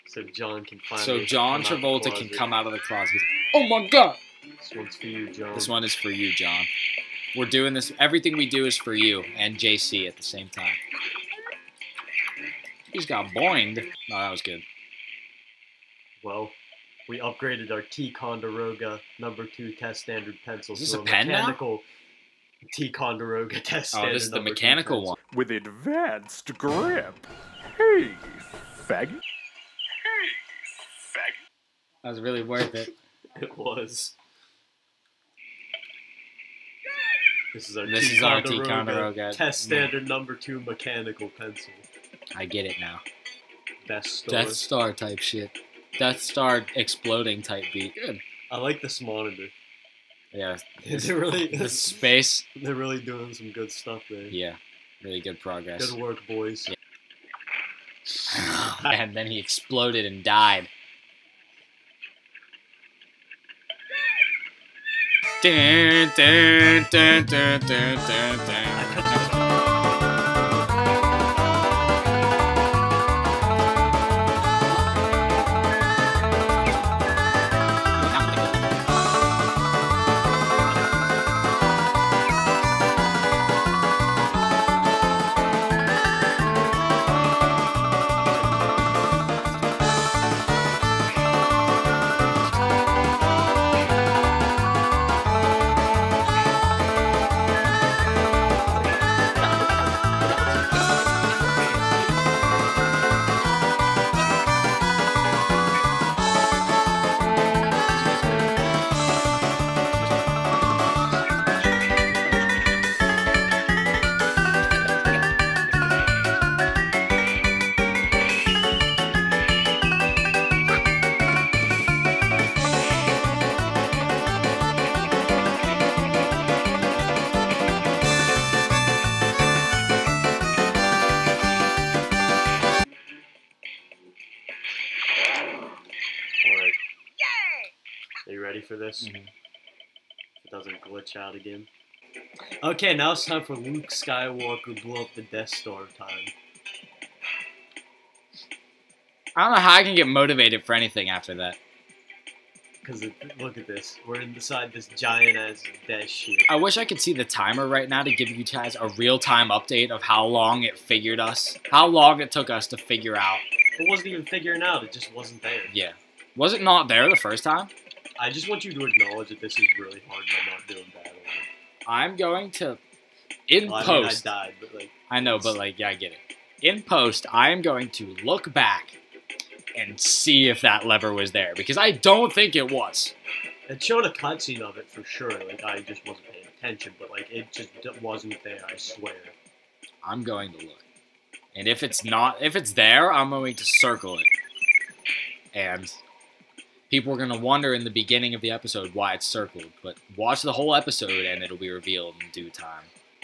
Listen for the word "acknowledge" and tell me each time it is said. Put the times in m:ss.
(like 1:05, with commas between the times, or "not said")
2:48.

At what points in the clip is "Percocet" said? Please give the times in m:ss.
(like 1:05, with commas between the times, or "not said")
not said.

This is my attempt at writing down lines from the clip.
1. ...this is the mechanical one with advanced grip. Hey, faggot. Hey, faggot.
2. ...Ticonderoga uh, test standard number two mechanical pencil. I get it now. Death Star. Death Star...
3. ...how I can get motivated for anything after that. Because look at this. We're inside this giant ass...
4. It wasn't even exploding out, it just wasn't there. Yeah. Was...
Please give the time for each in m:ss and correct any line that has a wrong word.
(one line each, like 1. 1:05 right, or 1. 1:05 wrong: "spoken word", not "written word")
1. 0:24 right
2. 0:38 right
3. 2:29 right
4. 2:43 wrong: "figuring", not "exploding".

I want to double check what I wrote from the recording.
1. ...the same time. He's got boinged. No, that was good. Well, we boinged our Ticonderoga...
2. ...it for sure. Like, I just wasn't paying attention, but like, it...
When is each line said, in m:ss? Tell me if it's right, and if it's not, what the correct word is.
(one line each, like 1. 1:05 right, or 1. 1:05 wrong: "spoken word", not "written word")
1. 0:10 wrong: "upgraded", not "boinged"
2. 3:04 right.